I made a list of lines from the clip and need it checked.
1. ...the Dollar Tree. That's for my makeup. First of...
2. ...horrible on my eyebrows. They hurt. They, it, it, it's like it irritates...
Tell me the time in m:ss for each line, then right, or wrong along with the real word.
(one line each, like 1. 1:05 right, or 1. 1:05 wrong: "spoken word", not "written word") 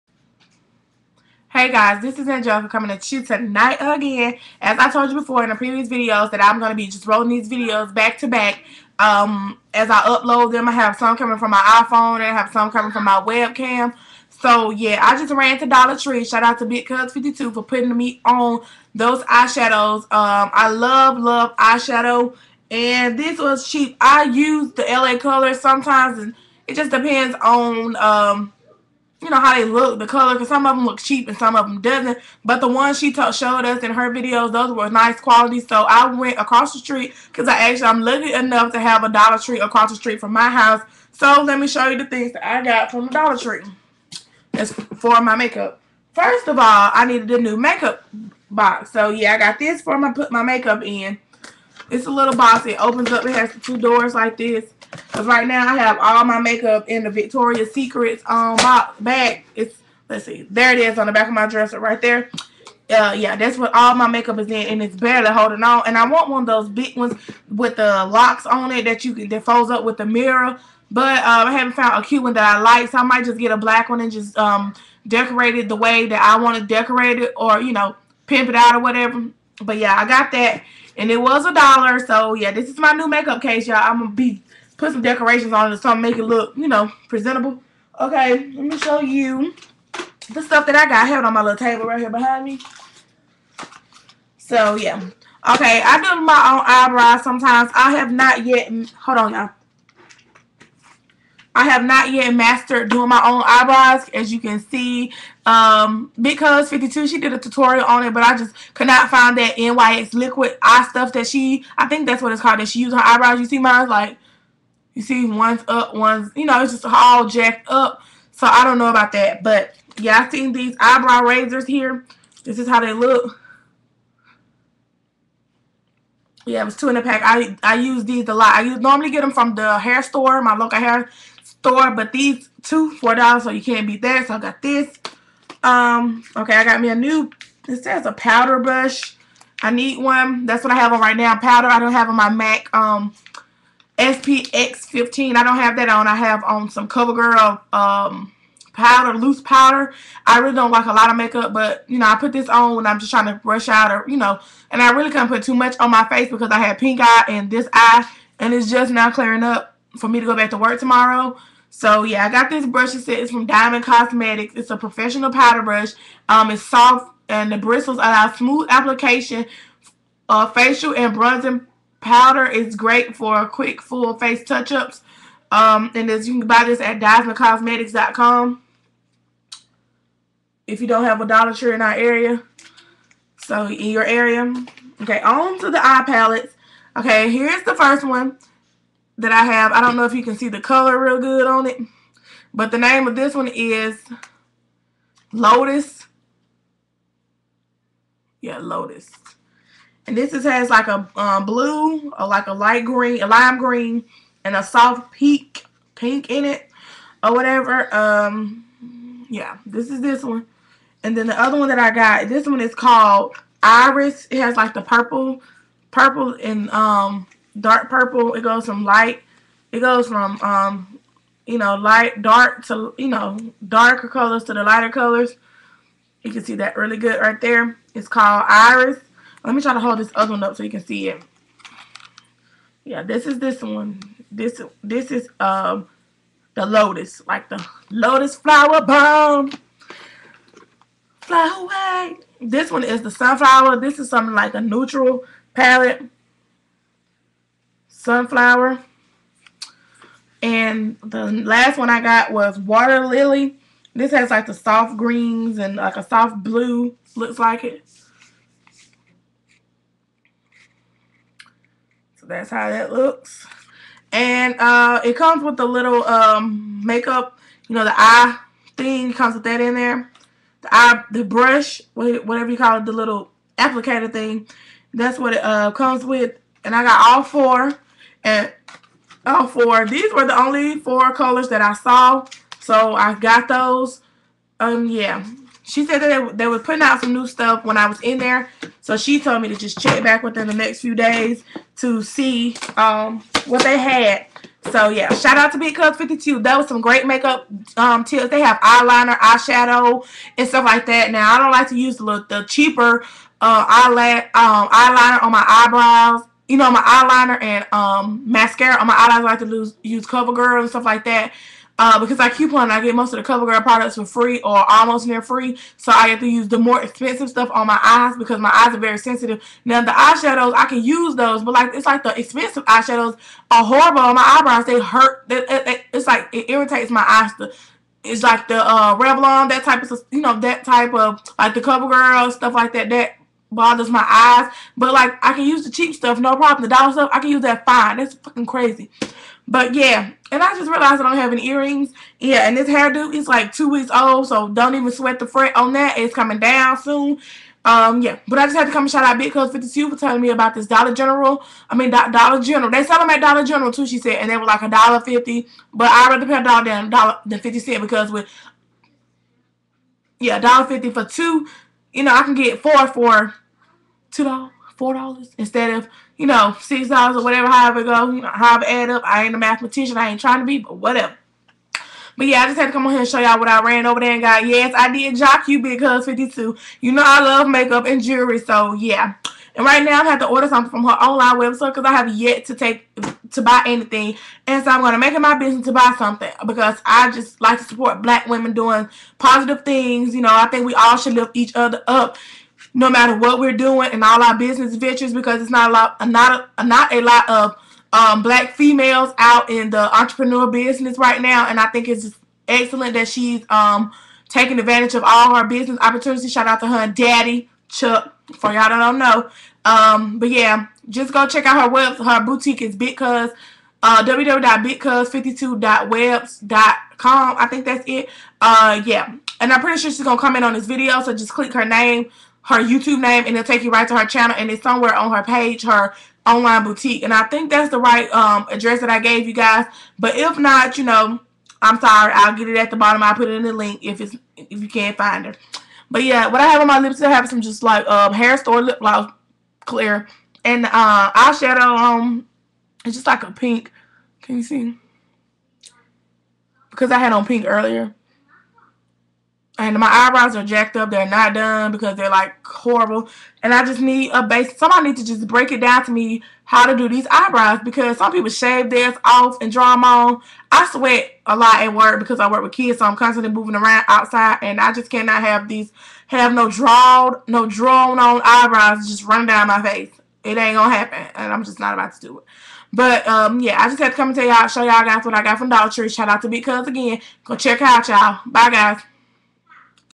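1. 0:43 right
2. 5:23 right.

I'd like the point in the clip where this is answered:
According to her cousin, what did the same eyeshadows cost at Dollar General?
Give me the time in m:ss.
5:54.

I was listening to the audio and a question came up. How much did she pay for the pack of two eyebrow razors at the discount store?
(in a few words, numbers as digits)
$4.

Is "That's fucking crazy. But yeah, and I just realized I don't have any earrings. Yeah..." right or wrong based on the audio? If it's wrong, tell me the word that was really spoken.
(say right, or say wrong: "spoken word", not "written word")
right.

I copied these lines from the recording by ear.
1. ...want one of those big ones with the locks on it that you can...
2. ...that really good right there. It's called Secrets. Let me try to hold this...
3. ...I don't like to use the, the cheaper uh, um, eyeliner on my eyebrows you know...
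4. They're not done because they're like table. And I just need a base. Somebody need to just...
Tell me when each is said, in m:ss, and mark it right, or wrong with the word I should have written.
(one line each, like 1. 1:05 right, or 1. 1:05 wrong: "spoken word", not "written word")
1. 1:06 right
2. 3:46 wrong: "Iris", not "Secrets"
3. 5:01 right
4. 7:30 wrong: "horrible", not "table".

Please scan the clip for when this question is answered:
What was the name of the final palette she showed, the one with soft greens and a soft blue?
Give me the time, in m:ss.
4:12.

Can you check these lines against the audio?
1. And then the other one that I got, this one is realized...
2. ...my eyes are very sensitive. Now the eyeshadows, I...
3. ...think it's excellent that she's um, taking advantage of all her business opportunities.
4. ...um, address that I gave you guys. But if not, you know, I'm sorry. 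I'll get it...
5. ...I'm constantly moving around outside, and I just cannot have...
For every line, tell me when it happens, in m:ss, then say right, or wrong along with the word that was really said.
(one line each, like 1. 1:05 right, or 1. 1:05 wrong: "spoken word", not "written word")
1. 3:31 wrong: "called", not "realized"
2. 5:18 right
3. 6:41 right
4. 7:08 right
5. 7:42 right.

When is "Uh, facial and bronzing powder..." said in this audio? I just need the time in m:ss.
2:50.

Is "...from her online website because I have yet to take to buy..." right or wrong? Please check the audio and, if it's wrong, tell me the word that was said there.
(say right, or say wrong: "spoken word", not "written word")
right.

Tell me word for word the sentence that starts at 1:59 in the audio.
But, yeah, I've seen these eyebrow razors here.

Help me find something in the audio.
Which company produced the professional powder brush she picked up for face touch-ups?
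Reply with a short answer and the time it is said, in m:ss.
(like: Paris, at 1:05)
Diamond Cosmetics, at 2:43.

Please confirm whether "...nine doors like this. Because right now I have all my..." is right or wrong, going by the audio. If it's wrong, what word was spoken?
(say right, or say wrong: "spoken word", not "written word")
wrong: "two", not "nine".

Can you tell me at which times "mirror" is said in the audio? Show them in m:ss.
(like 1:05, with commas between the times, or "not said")
1:10.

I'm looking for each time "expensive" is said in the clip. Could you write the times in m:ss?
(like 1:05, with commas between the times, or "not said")
5:16, 5:22.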